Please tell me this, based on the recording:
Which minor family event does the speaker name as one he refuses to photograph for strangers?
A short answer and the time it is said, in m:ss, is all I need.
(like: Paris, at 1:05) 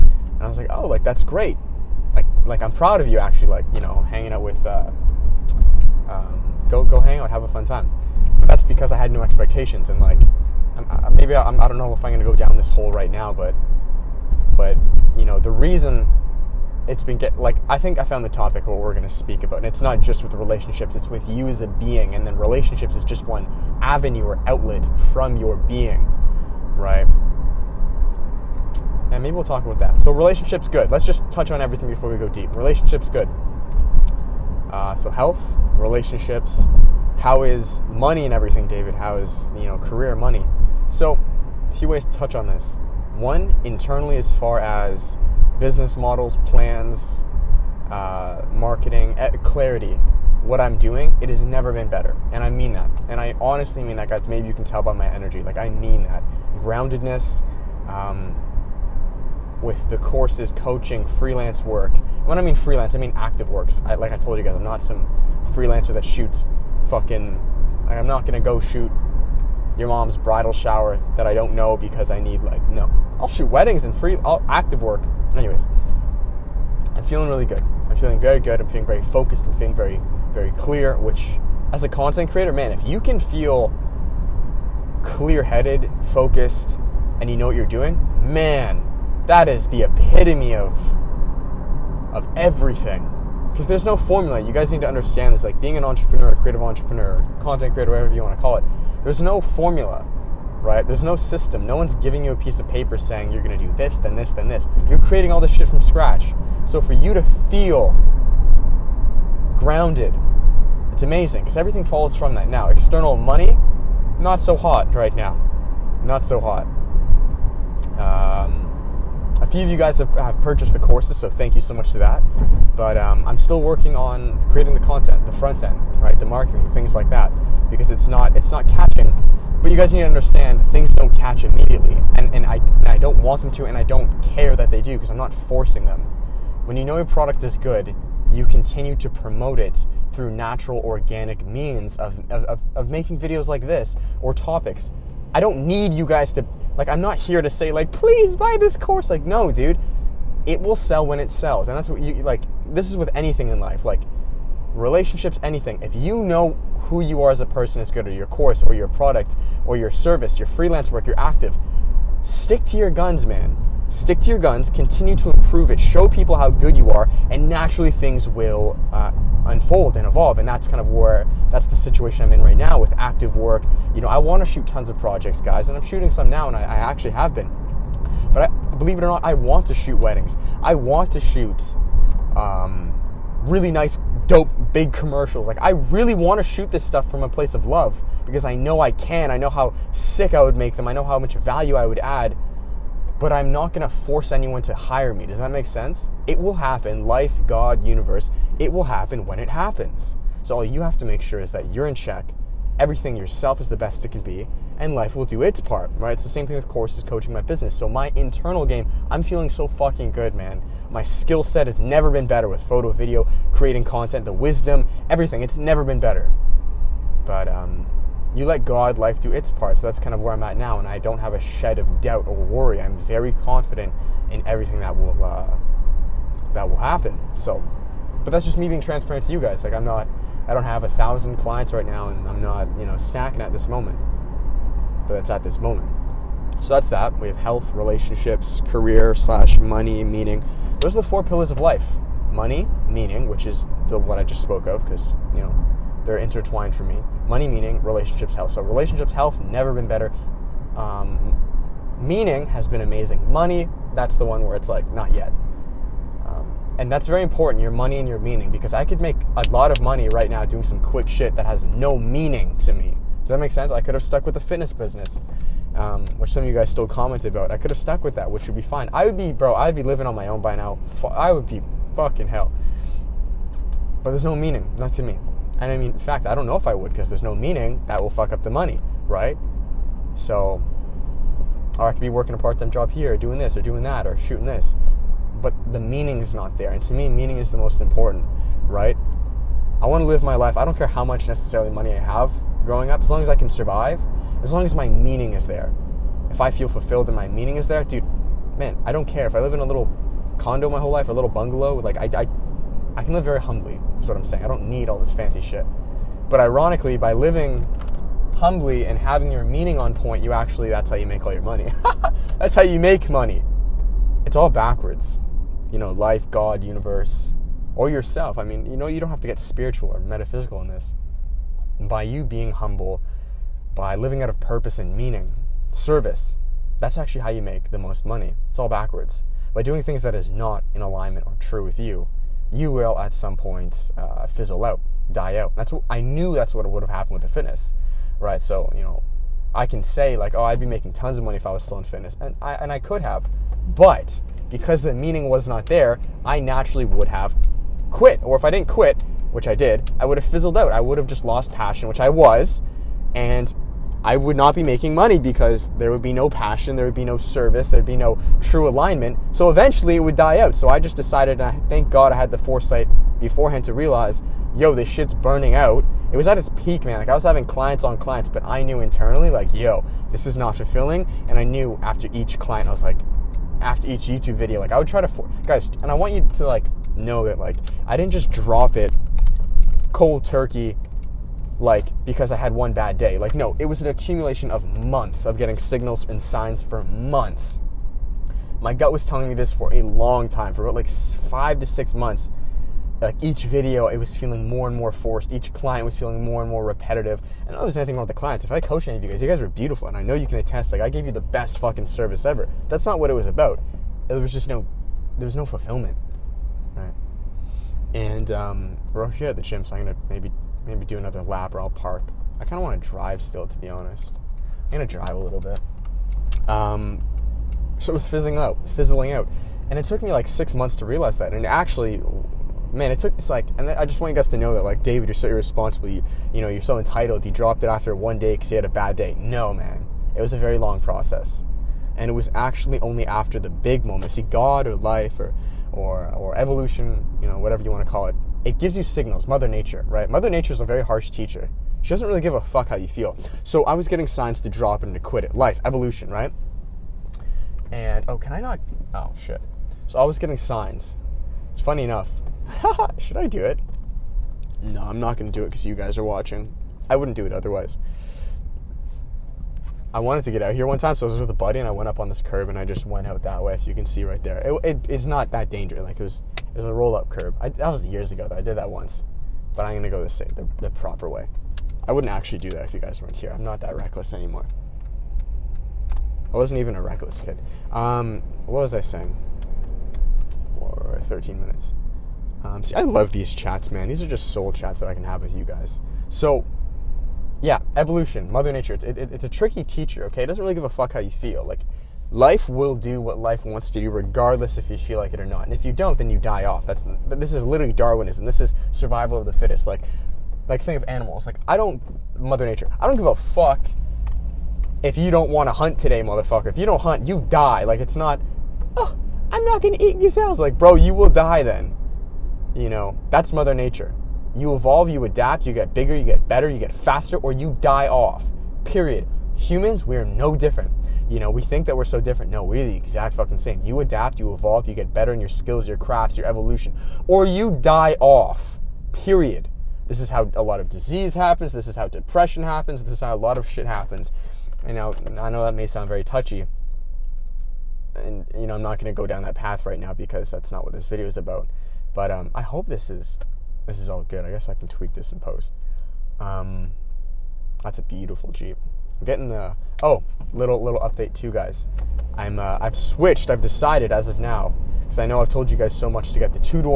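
bridal shower, at 1:10.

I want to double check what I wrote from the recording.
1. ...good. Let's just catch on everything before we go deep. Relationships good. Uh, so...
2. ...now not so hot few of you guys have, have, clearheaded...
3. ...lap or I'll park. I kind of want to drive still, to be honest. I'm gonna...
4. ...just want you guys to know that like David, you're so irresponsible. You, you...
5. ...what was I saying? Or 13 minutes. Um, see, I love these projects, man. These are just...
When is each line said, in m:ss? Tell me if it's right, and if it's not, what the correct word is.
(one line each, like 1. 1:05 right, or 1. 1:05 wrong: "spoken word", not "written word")
1. 0:30 wrong: "touch", not "catch"
2. 1:55 wrong: "purchased", not "clearheaded"
3. 6:51 right
4. 7:03 right
5. 7:58 wrong: "chats", not "projects".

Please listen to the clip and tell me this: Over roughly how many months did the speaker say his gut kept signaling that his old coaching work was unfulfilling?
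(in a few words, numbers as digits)
5 to 6 months.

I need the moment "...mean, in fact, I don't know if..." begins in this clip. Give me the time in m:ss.
4:35.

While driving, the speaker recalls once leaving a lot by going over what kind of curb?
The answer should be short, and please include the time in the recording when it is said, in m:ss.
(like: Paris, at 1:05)
roll up curb, at 7:46.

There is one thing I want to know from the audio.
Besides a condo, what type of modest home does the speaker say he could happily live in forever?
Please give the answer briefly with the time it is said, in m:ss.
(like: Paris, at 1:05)
bungalow, at 5:01.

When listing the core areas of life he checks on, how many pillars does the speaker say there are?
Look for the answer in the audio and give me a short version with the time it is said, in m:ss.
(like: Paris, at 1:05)
4, at 4:01.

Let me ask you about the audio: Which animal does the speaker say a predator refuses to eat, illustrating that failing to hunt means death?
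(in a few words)
gazelles.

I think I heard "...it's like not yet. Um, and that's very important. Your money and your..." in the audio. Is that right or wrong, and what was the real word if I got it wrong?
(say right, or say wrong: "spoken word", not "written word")
right.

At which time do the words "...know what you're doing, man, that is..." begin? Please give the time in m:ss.
1:27.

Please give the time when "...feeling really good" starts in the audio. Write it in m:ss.
1:17.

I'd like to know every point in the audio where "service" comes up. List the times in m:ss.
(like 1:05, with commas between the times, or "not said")
2:39, 5:25, 5:57, 6:41.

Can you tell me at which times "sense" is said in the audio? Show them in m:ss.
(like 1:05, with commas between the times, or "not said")
3:15, 4:23.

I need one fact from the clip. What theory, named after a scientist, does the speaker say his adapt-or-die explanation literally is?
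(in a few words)
Darwinism.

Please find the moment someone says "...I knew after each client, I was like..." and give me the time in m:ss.
6:11.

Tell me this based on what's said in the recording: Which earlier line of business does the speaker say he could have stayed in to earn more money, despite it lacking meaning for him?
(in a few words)
fitness business.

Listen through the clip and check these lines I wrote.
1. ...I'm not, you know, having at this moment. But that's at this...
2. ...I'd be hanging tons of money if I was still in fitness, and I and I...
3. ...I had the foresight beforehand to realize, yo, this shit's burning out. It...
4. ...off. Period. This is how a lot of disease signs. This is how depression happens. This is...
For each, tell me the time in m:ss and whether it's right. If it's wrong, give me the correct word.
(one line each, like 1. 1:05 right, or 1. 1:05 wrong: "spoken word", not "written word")
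1. 3:52 wrong: "snacking", not "having"
2. 5:40 wrong: "making", not "hanging"
3. 6:02 right
4. 8:48 wrong: "happens", not "signs".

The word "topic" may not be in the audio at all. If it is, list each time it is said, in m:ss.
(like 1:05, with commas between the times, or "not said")
0:18, 2:24.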